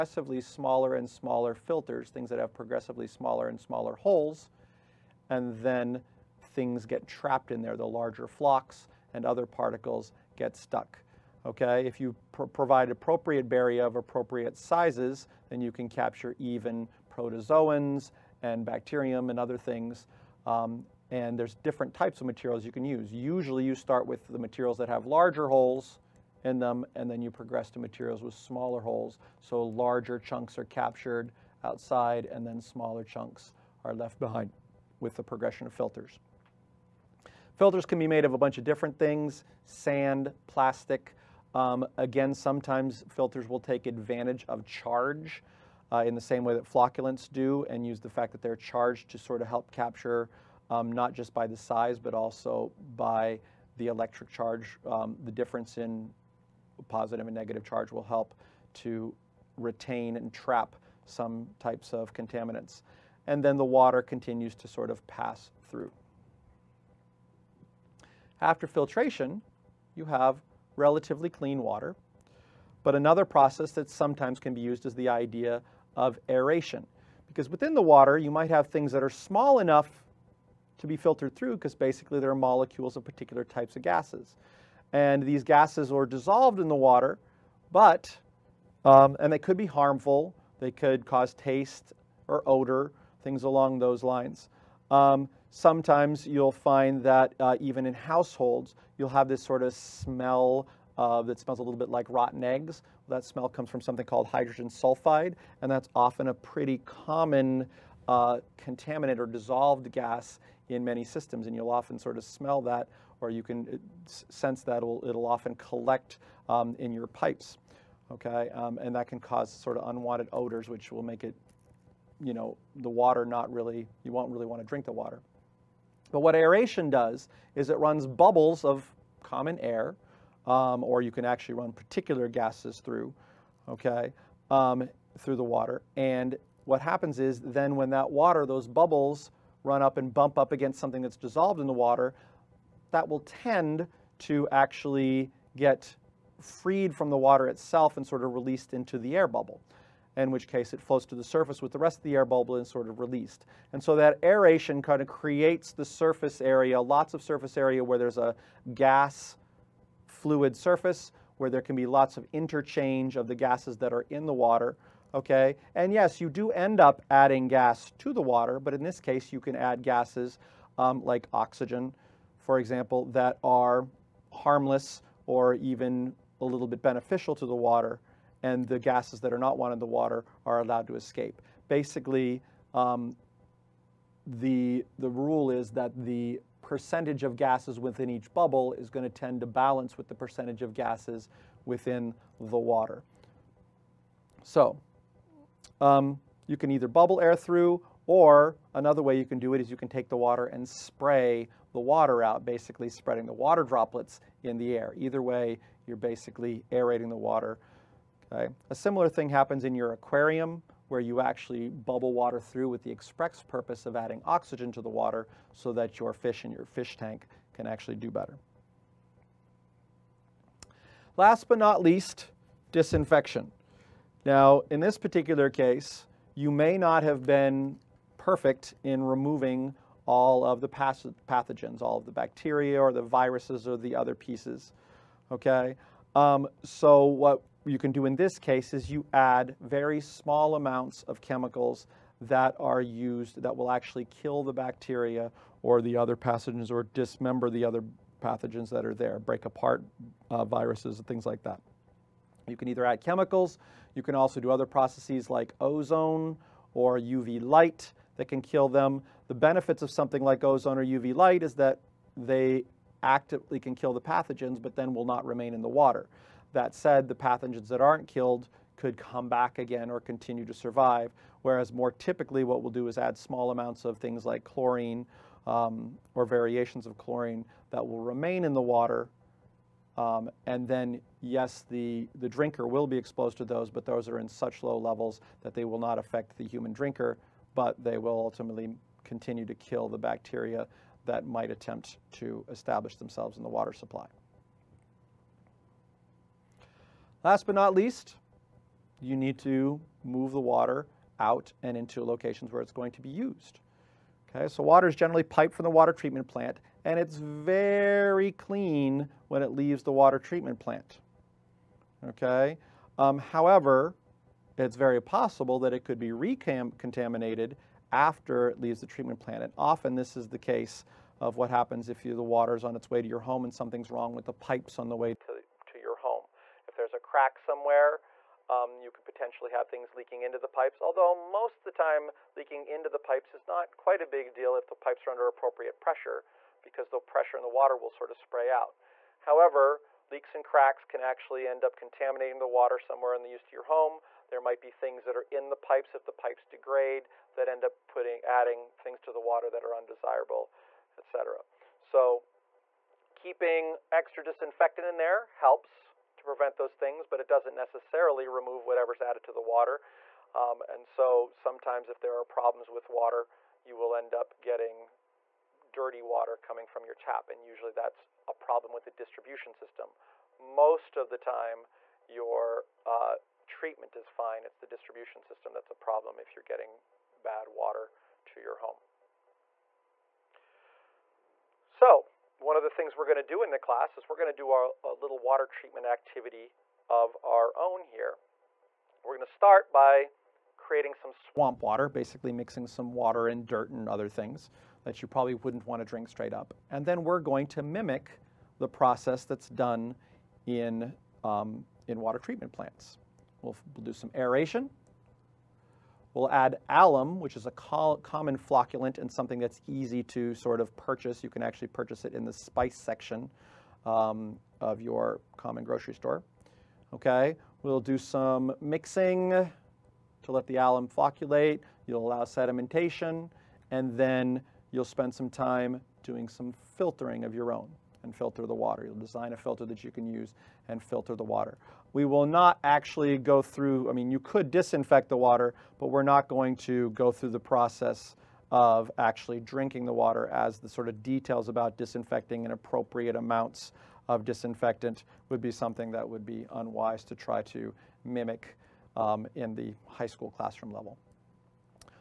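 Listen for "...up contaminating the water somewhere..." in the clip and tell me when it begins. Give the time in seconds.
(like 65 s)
341 s.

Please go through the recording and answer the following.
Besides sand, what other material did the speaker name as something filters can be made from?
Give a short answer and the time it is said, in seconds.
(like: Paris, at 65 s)
plastic, at 40 s.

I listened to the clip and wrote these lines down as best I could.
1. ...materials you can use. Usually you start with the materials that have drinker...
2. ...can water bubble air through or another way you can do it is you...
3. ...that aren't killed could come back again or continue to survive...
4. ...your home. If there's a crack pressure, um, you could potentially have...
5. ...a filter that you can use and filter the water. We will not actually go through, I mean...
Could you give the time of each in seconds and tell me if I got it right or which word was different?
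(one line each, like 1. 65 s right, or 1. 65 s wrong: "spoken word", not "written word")
1. 22 s wrong: "larger", not "drinker"
2. 196 s wrong: "either", not "water"
3. 267 s right
4. 325 s wrong: "somewhere", not "pressure"
5. 429 s right.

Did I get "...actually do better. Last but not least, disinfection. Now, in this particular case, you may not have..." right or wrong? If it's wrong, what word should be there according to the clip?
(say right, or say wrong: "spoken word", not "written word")
right.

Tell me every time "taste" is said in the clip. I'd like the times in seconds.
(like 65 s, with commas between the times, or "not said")
91 s.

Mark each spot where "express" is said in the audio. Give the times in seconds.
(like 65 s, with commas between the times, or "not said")
212 s.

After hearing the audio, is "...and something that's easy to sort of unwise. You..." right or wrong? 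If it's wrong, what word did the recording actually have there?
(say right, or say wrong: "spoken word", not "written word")
wrong: "purchase", not "unwise".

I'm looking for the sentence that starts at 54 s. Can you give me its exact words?
Um, the difference in positive and negative charge will help to retain and trap some types of contaminants.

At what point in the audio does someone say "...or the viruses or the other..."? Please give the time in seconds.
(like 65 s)
232 s.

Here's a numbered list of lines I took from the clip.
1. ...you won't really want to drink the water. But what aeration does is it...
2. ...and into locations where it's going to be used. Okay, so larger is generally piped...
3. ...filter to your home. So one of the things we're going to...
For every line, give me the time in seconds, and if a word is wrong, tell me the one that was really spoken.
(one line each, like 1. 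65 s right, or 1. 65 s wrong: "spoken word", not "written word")
1. 124 s right
2. 301 s wrong: "water", not "larger"
3. 377 s wrong: "water", not "filter".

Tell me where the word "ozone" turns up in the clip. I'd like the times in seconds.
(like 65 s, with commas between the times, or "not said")
255 s, 260 s.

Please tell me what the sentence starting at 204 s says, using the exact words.
Either way, you're basically aerating the water.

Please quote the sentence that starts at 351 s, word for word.
So keeping extra disinfectant in there helps to prevent those things, but it doesn't necessarily remove whatever's added to the water.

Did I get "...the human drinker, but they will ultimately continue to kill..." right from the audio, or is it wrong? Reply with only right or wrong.
right.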